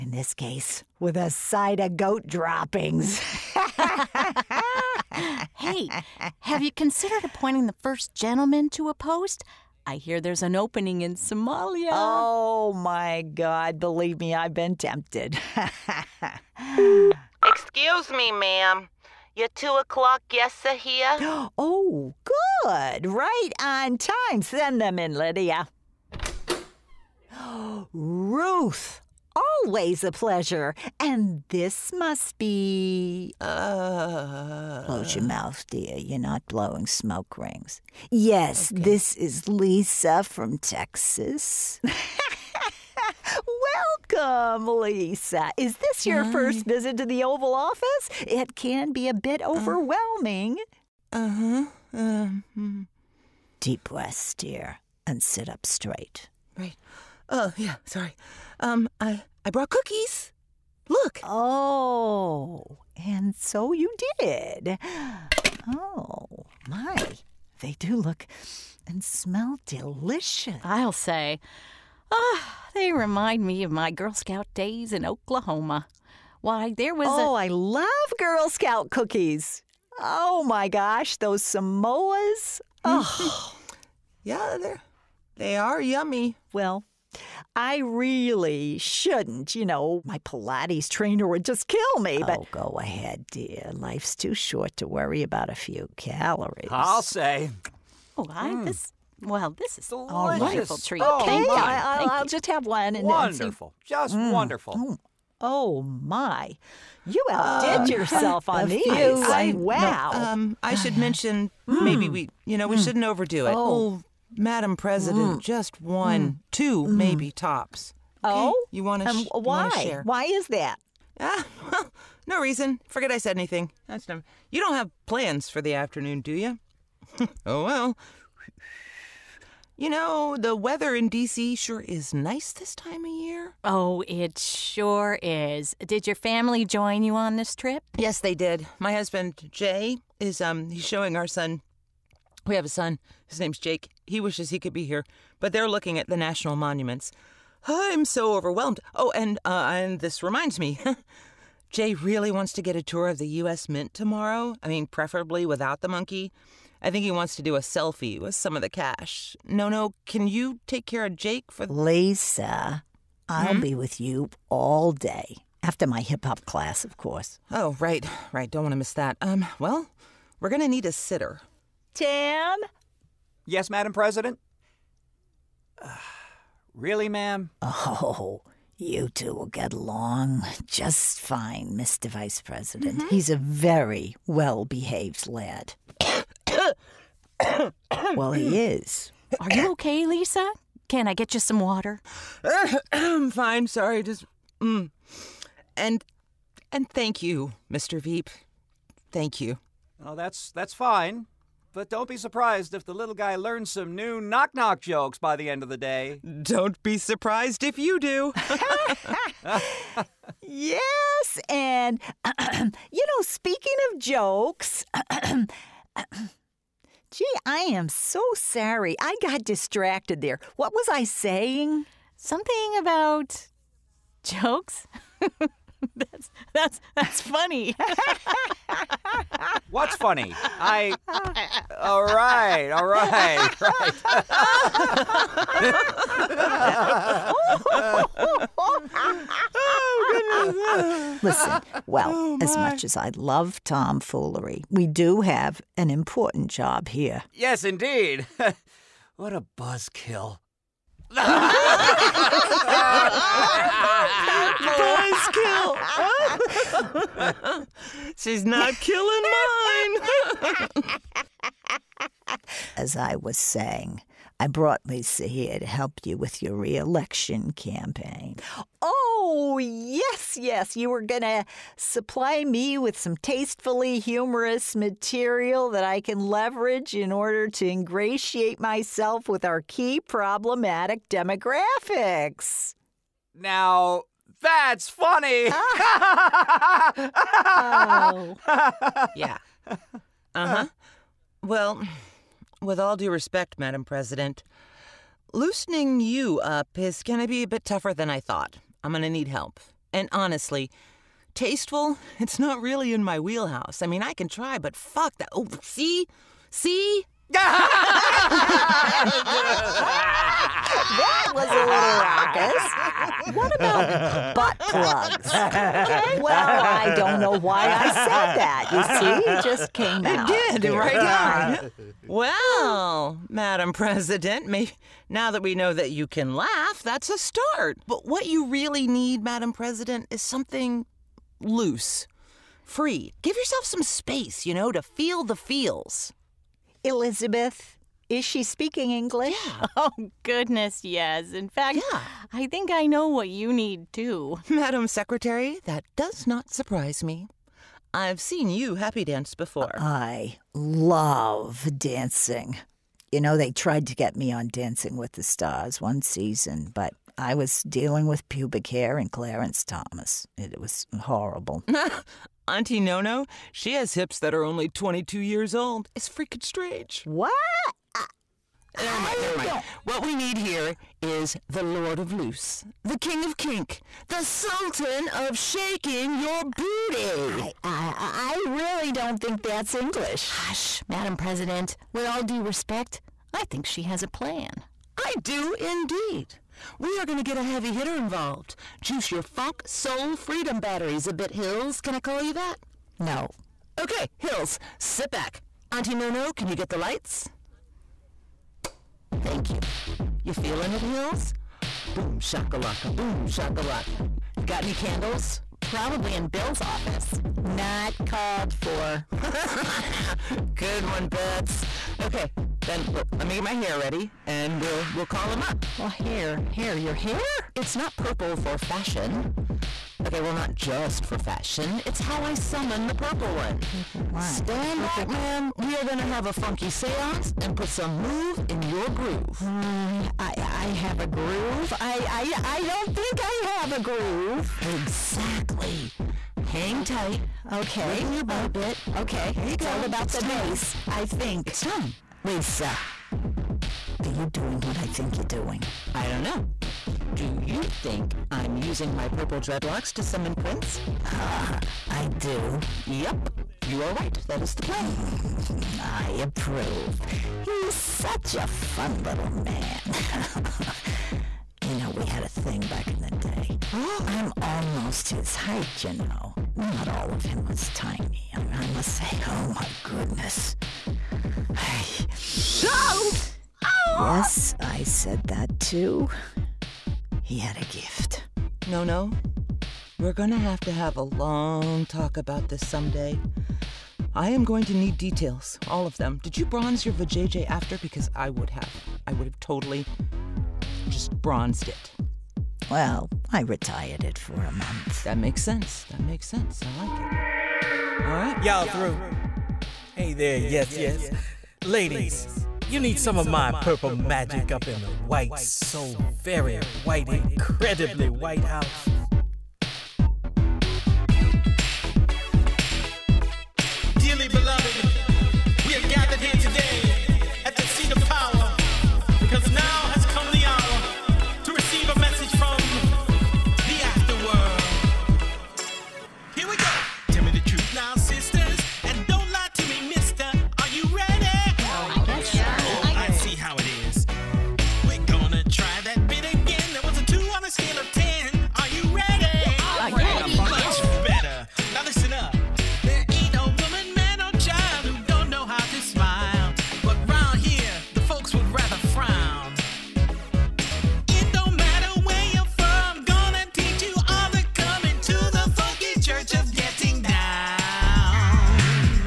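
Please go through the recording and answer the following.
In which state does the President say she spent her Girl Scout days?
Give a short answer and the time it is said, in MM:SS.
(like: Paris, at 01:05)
Oklahoma, at 01:15.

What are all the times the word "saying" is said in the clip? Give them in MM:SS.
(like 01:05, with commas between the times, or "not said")
03:41, 04:23.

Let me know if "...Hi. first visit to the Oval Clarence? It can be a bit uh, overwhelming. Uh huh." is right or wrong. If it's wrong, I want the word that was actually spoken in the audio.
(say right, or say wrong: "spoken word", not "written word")
wrong: "Office", not "Clarence".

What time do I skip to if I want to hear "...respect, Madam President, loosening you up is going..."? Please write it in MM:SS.
04:53.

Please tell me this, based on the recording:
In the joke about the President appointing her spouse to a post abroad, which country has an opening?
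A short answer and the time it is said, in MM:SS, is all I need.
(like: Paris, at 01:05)
Somalia, at 00:11.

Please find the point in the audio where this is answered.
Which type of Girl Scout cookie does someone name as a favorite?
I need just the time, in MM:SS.
01:21.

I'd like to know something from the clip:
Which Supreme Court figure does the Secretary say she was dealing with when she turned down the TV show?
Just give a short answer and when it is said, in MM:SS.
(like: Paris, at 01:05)
Clarence Thomas, at 05:59.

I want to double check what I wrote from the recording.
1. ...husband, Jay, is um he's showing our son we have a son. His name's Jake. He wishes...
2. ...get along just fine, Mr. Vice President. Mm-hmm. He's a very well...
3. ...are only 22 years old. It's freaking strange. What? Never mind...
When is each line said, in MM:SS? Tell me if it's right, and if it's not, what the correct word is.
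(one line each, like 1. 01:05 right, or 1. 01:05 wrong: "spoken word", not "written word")
1. 02:18 right
2. 02:59 right
3. 06:04 right.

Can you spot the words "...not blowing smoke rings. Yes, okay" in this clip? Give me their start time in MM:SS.
00:36.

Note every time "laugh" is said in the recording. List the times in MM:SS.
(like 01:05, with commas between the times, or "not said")
05:26.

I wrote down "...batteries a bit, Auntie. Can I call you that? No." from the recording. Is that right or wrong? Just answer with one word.
wrong.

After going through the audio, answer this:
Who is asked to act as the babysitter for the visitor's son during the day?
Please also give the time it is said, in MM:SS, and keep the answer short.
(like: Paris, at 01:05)
Tim, at 02:51.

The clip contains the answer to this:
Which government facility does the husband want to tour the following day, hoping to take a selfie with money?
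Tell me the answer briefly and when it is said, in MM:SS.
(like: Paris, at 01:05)
U.S. Mint, at 02:33.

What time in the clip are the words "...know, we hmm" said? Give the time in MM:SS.
01:52.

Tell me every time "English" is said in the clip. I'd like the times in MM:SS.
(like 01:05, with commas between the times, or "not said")
05:38, 06:19.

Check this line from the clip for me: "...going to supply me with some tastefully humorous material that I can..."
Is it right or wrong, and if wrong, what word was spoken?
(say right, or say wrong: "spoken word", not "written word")
right.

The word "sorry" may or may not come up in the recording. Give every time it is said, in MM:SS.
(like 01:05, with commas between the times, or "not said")
00:57, 03:13, 03:38.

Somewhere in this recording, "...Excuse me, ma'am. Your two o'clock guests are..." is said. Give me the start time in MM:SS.
00:17.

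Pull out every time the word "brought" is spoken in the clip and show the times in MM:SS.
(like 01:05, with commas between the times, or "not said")
00:59, 04:24.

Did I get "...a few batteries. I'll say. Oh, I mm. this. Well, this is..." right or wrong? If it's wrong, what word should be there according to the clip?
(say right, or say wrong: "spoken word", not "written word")
wrong: "calories", not "batteries".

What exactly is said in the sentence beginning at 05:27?
But what you really need, Madam President, is something loose, free.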